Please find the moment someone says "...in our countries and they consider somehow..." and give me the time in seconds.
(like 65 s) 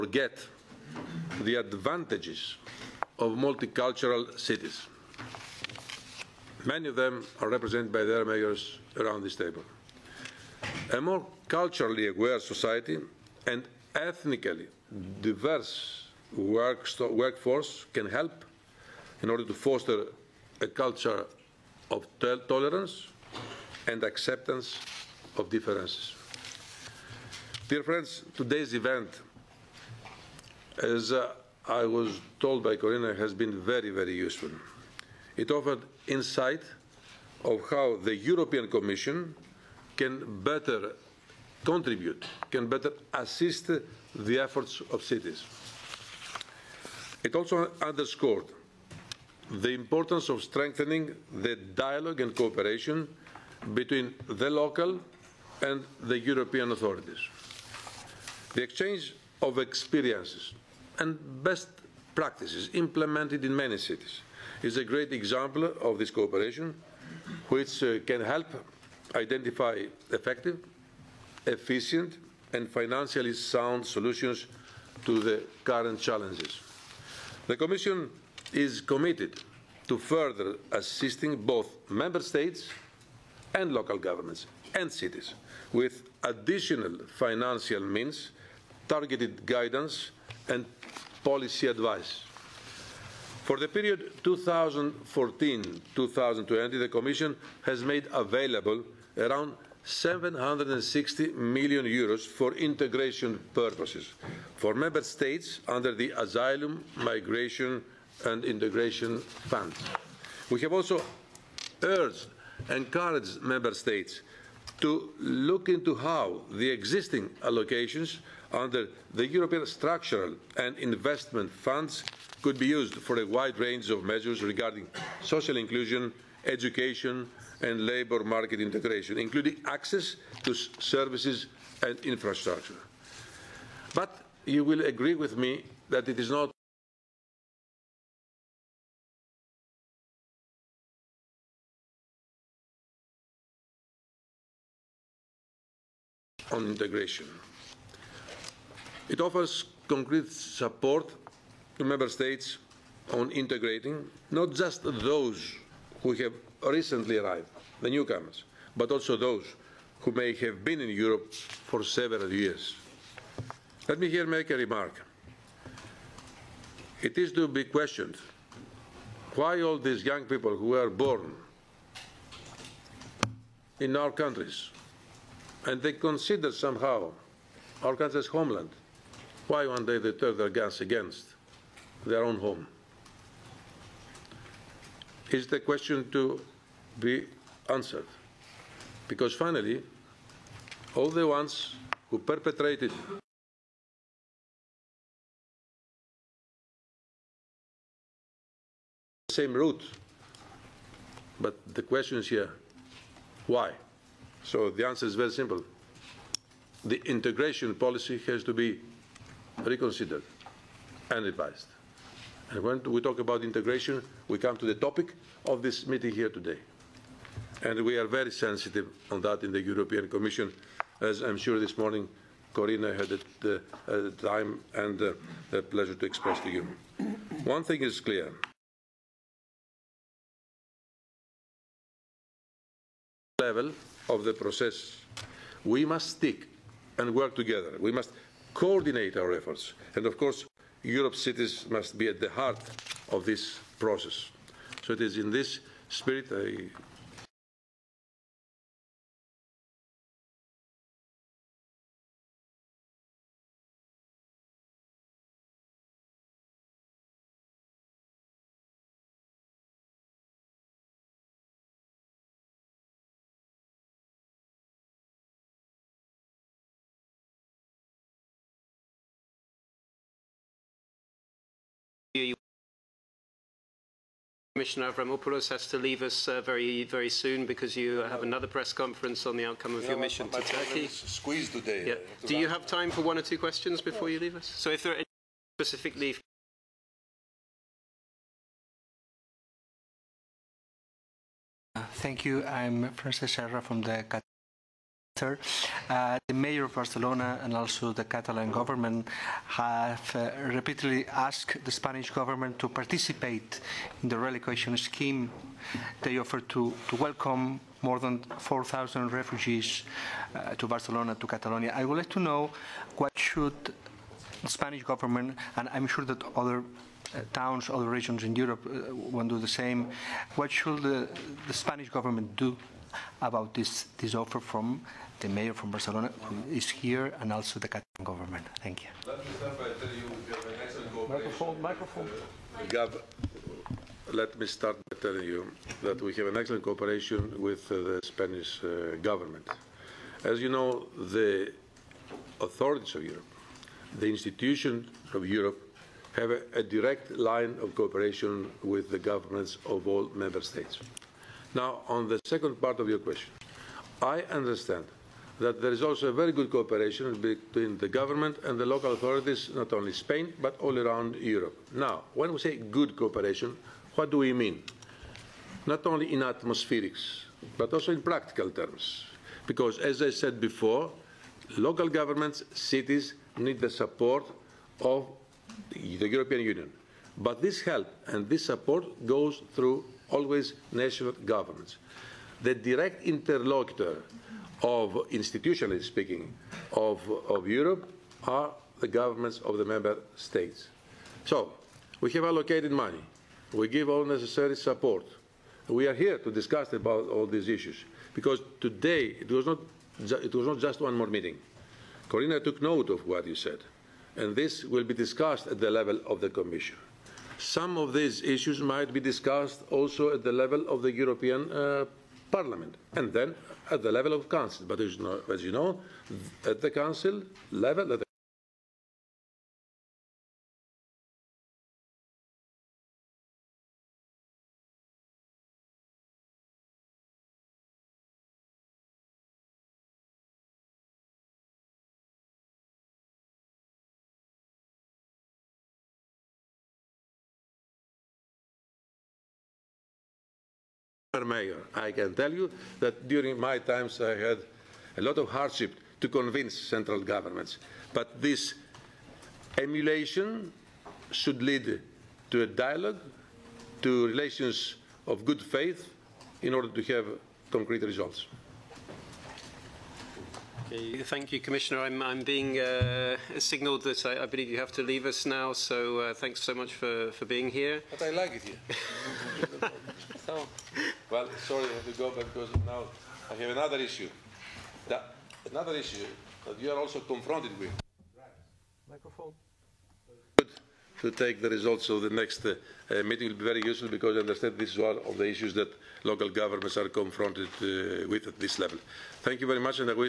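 173 s.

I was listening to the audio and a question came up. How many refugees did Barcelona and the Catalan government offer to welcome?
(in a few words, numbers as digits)
more than 4,000.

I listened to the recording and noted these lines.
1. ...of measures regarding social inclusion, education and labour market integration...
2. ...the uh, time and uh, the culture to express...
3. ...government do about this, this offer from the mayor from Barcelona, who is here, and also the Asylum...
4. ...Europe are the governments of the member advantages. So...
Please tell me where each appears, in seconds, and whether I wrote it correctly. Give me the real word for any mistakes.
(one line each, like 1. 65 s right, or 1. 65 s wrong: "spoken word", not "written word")
1. 123 s right
2. 223 s wrong: "pleasure", not "culture"
3. 321 s wrong: "Catalan", not "Asylum"
4. 387 s wrong: "states", not "advantages".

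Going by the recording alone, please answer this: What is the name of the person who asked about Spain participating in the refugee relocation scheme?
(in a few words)
Francis Serra.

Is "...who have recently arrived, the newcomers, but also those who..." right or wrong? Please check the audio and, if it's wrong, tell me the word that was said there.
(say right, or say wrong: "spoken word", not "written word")
right.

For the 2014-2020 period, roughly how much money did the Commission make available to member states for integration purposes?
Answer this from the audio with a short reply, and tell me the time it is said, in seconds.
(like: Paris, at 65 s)
760 million euros, at 99 s.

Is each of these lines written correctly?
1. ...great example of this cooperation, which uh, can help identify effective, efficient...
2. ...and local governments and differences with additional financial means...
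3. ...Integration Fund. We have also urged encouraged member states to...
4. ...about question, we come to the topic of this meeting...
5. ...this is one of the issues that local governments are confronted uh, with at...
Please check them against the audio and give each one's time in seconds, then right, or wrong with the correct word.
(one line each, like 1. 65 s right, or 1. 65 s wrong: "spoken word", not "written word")
1. 64 s right
2. 83 s wrong: "cities", not "differences"
3. 108 s right
4. 213 s wrong: "integration", not "question"
5. 484 s right.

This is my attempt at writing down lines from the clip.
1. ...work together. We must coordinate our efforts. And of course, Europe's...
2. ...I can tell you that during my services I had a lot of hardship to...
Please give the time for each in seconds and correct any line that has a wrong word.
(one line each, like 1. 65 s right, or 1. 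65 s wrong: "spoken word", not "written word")
1. 237 s right
2. 441 s wrong: "times", not "services".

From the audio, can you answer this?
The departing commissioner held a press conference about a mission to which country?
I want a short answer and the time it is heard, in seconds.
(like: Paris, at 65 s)
Turkey, at 280 s.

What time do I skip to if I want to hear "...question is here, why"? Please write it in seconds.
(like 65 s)
201 s.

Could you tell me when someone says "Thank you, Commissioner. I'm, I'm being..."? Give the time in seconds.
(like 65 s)
461 s.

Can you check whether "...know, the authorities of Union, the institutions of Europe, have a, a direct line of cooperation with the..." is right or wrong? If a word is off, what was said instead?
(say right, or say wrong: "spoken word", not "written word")
wrong: "Europe", not "Union".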